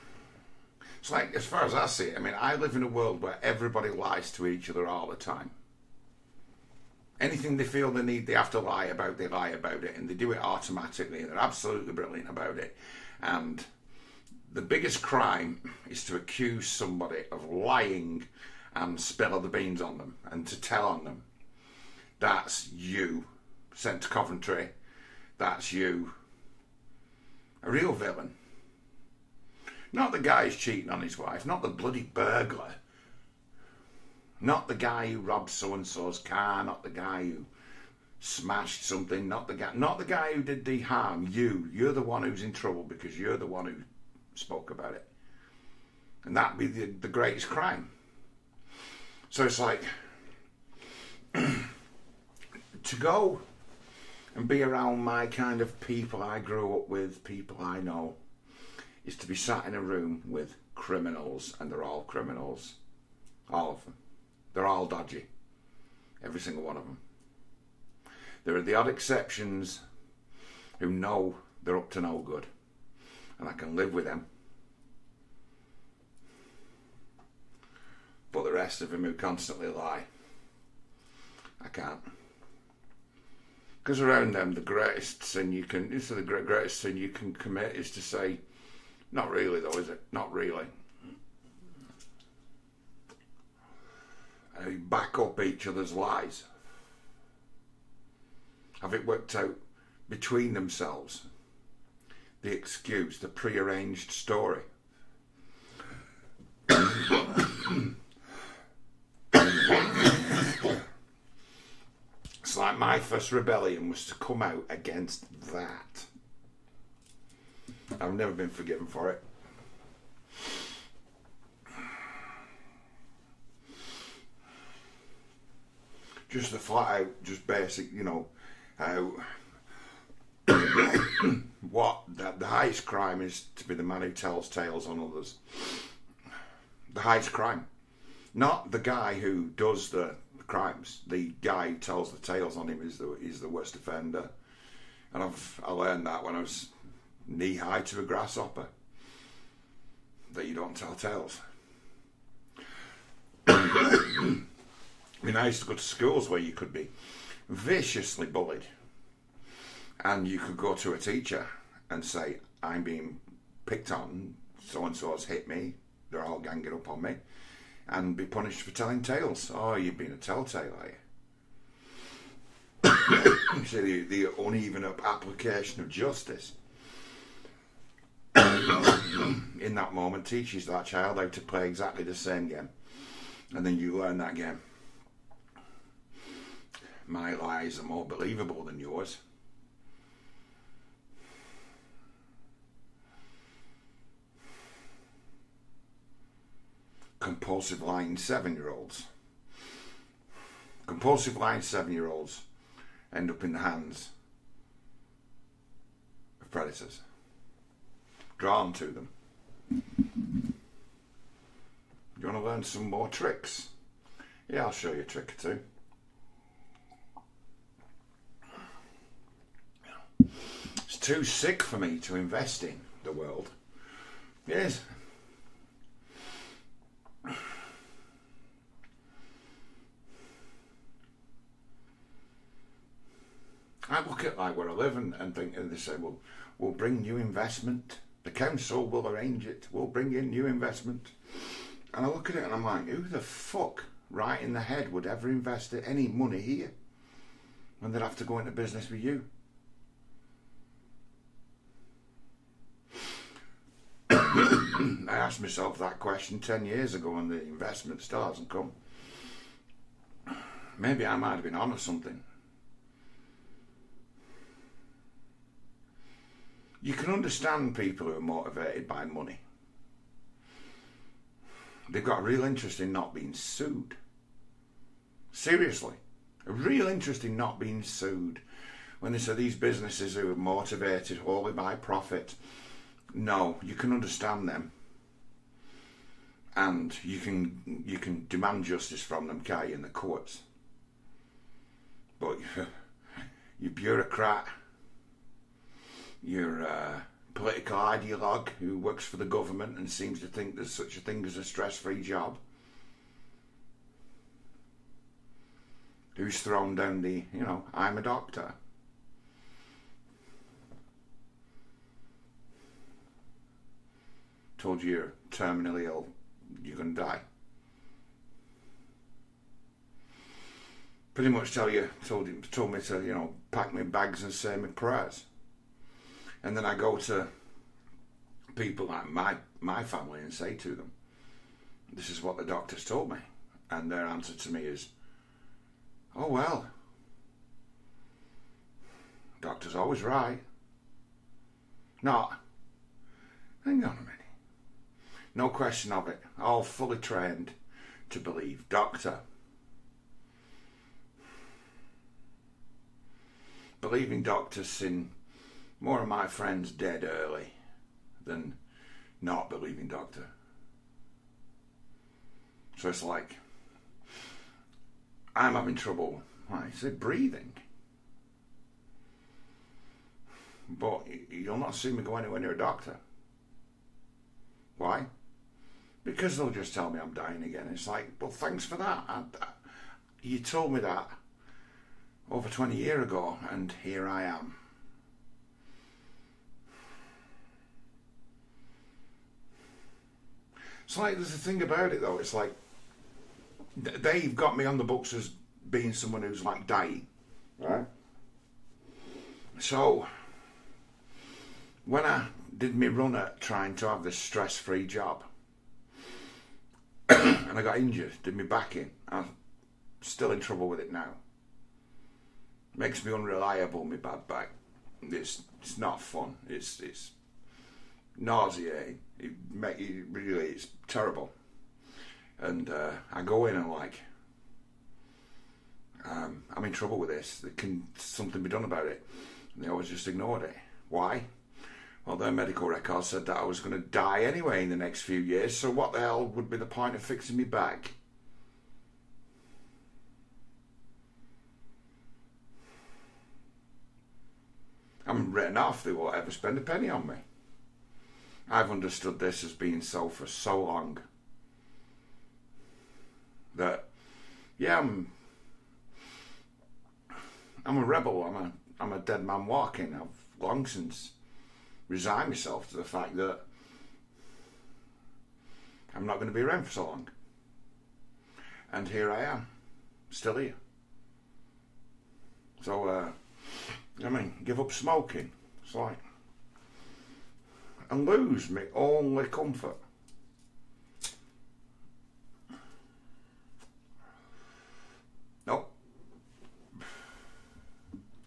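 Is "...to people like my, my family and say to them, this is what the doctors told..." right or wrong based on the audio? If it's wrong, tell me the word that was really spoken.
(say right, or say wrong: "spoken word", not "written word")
right.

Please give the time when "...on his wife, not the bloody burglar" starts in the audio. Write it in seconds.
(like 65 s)
30 s.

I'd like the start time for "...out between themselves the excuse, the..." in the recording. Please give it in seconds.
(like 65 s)
99 s.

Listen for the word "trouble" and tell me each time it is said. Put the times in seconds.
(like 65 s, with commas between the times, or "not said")
42 s, 365 s, 410 s, 426 s.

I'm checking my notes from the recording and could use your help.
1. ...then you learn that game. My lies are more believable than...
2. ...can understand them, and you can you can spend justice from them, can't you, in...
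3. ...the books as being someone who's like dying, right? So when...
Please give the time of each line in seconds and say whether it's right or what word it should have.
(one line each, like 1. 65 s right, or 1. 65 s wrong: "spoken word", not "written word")
1. 183 s right
2. 283 s wrong: "demand", not "spend"
3. 394 s right.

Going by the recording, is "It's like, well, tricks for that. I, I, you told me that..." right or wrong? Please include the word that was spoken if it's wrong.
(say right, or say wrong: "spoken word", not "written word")
wrong: "thanks", not "tricks".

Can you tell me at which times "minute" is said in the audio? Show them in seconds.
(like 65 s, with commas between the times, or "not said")
343 s.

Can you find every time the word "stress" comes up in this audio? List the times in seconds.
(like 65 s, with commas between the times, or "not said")
301 s, 404 s.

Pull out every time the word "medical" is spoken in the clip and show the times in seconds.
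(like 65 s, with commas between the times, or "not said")
432 s.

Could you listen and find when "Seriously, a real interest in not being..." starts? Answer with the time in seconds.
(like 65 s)
275 s.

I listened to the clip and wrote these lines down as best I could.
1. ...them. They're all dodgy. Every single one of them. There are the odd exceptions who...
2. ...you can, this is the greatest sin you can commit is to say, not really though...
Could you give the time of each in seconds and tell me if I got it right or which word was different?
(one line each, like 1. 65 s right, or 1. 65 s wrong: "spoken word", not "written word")
1. 63 s right
2. 85 s right.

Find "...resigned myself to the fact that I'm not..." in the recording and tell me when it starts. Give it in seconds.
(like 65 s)
461 s.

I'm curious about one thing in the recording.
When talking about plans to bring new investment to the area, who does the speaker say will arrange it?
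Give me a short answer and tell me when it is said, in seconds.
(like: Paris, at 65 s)
The council, at 238 s.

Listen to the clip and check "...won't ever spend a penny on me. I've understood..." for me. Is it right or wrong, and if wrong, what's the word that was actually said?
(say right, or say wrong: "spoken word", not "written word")
right.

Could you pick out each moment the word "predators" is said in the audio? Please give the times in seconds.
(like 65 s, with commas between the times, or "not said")
206 s.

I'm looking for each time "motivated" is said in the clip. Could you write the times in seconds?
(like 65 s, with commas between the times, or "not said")
268 s, 280 s.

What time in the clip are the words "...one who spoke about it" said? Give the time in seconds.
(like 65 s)
43 s.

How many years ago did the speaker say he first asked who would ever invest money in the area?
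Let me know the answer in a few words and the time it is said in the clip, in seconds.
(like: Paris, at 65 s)
10, at 256 s.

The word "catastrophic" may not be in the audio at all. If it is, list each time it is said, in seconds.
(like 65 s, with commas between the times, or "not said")
not said.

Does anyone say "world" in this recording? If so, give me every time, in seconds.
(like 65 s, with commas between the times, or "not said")
2 s, 223 s.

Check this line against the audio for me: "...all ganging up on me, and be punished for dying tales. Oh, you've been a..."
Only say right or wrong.
wrong.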